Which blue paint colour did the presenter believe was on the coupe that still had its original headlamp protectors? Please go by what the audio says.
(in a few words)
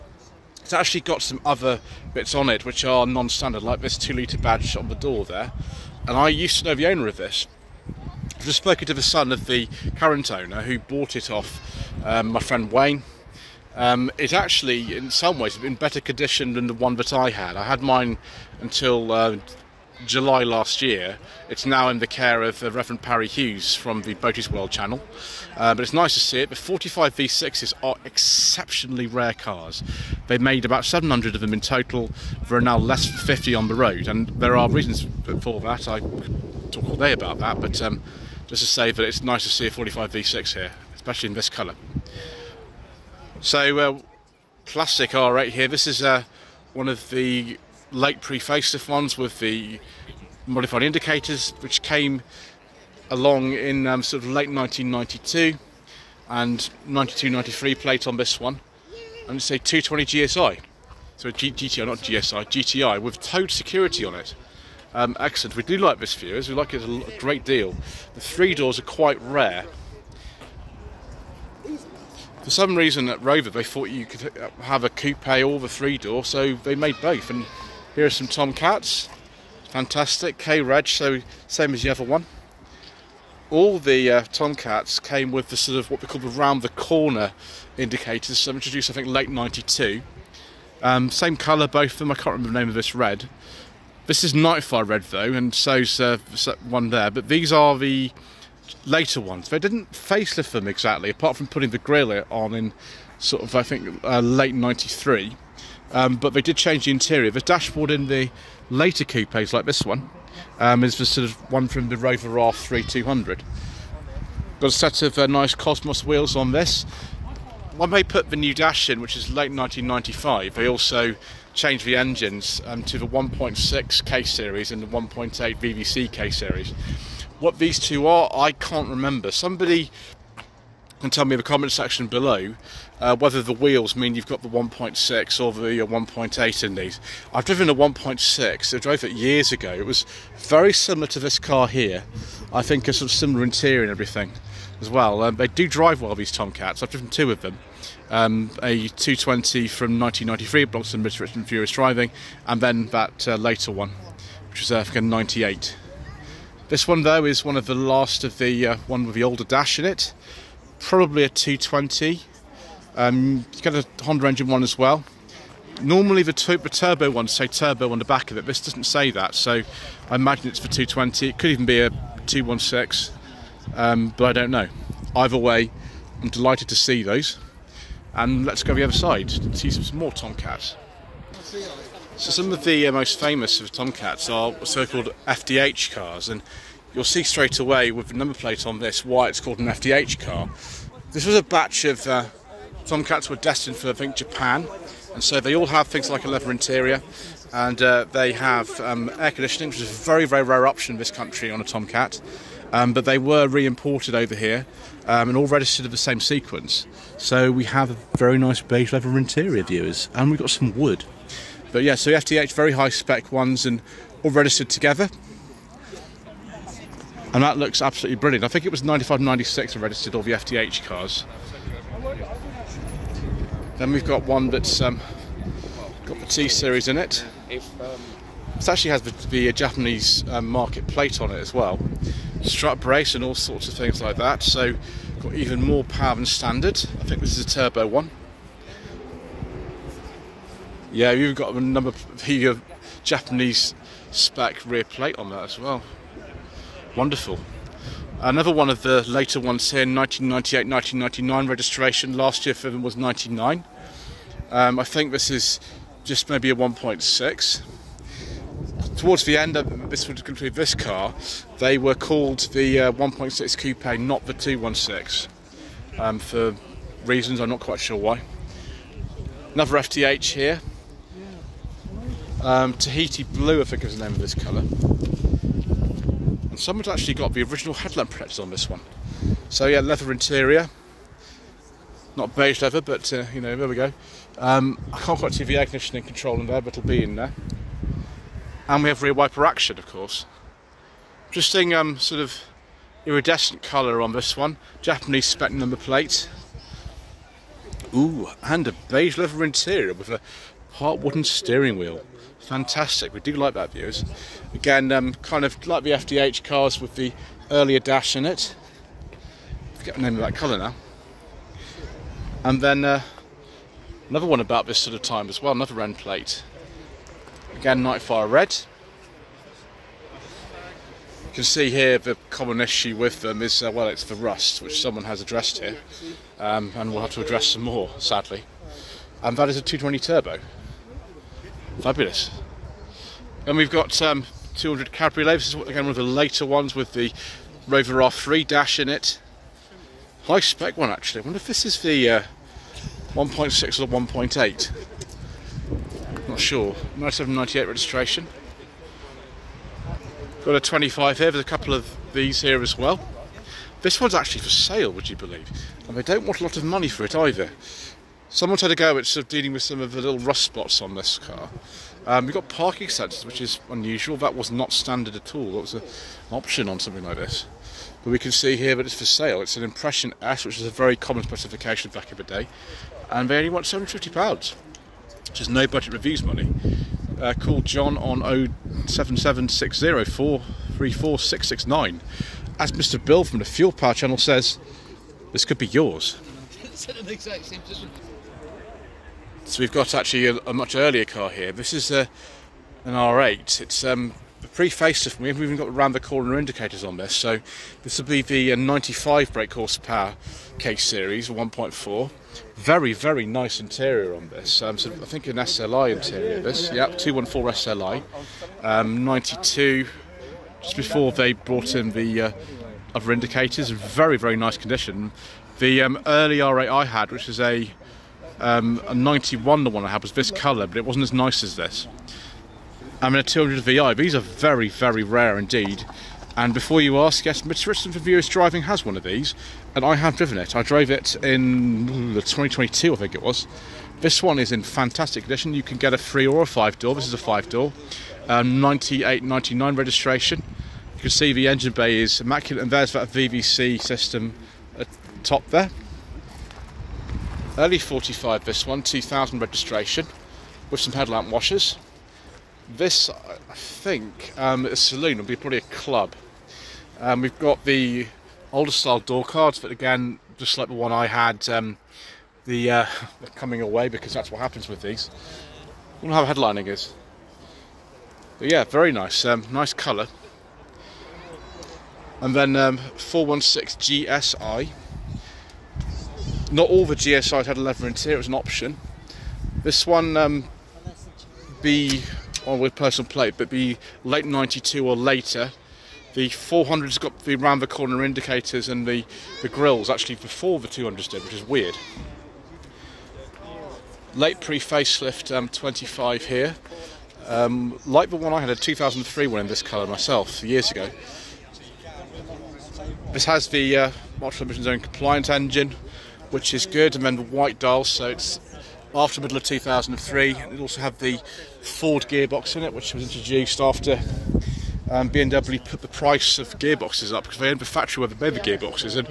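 Tahiti Blue.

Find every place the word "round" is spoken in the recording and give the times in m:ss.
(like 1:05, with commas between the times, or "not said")
1:26, 6:35, 8:07.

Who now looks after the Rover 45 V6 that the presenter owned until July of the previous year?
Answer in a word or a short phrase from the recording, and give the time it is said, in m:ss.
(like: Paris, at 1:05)
Reverend Parry Hughes, at 0:22.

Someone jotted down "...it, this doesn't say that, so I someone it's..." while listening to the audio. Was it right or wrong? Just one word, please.
wrong.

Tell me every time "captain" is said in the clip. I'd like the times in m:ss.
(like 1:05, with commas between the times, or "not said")
not said.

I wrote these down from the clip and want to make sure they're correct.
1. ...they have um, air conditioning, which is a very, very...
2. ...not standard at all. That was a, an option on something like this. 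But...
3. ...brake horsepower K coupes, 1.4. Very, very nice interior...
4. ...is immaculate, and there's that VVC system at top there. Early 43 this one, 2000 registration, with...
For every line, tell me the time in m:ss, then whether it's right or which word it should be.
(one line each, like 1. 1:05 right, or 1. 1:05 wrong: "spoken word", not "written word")
1. 3:18 right
2. 6:04 right
3. 6:39 wrong: "series", not "coupes"
4. 7:21 wrong: "45", not "43".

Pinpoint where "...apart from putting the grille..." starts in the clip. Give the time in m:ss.
1:41.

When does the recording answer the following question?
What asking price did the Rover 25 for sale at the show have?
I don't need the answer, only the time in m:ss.
6:13.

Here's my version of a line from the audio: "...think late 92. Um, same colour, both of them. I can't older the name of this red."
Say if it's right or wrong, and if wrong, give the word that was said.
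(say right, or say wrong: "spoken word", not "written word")
wrong: "remember", not "older".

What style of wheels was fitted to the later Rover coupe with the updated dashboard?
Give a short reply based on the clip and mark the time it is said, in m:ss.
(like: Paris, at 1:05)
Cosmos wheels, at 1:55.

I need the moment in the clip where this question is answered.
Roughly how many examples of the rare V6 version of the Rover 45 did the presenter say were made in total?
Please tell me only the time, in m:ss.
0:30.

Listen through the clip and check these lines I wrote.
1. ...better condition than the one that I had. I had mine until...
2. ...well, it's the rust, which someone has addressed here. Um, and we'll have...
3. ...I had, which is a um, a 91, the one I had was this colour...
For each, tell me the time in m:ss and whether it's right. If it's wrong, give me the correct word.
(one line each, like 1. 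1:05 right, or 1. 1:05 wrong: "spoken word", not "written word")
1. 0:15 right
2. 5:23 right
3. 6:56 right.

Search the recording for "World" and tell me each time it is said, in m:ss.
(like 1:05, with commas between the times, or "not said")
0:24.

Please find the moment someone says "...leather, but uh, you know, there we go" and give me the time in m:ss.
4:42.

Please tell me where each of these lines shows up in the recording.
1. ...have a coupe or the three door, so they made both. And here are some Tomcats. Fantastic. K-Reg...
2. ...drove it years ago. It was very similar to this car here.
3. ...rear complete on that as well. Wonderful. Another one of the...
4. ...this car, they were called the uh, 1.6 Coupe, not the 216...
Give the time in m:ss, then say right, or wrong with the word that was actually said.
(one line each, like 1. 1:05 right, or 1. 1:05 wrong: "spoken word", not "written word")
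1. 1:14 right
2. 2:18 right
3. 4:04 wrong: "plate", not "complete"
4. 4:20 right.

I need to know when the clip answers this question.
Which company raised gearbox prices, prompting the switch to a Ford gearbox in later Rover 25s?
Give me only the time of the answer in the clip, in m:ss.
8:35.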